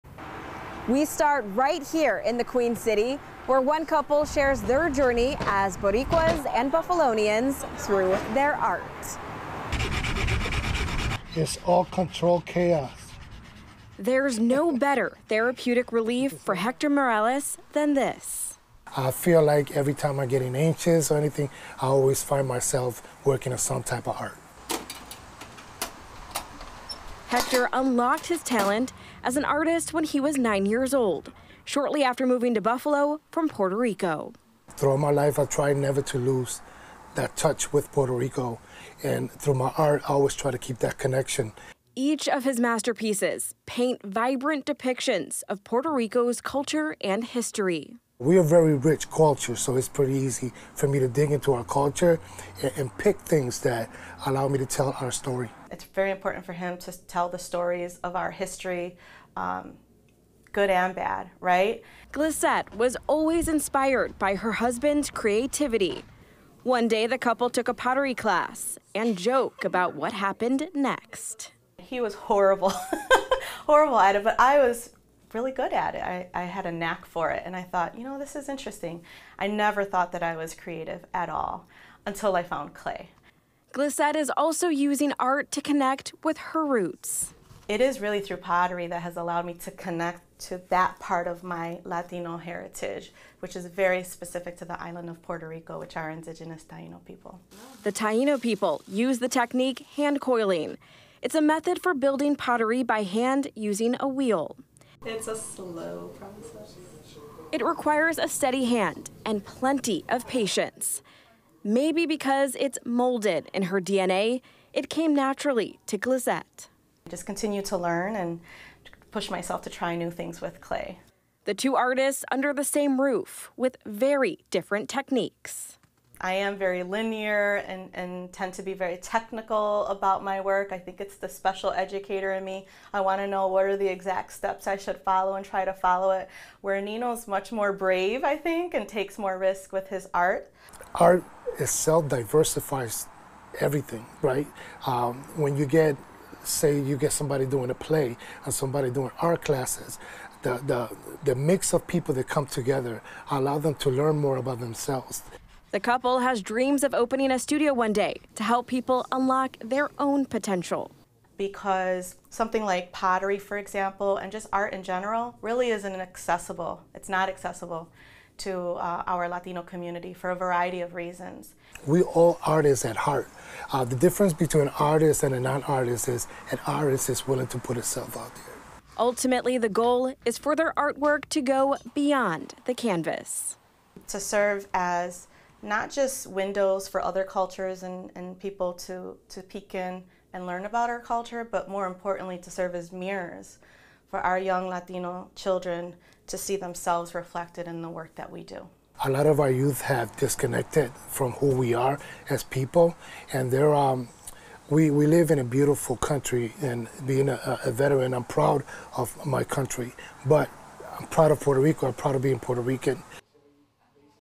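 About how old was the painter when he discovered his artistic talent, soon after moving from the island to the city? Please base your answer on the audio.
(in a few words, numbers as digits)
9.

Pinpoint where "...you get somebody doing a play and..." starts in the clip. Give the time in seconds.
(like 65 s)
146 s.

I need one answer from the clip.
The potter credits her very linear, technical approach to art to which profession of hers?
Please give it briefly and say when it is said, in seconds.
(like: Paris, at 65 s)
Special educator, at 131 s.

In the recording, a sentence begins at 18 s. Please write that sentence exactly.
I feel like every time I'm getting anxious or anything, I always find myself working on some type of art.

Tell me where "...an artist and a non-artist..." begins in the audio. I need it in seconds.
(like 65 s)
174 s.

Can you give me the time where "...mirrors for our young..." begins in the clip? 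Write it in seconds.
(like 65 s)
192 s.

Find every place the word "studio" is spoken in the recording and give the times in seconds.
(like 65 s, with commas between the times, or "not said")
157 s.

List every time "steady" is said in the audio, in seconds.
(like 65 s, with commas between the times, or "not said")
108 s.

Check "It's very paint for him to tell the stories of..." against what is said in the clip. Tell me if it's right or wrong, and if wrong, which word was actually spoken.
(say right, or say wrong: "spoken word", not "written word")
wrong: "important", not "paint".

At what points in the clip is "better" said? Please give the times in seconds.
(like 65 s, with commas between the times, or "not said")
14 s.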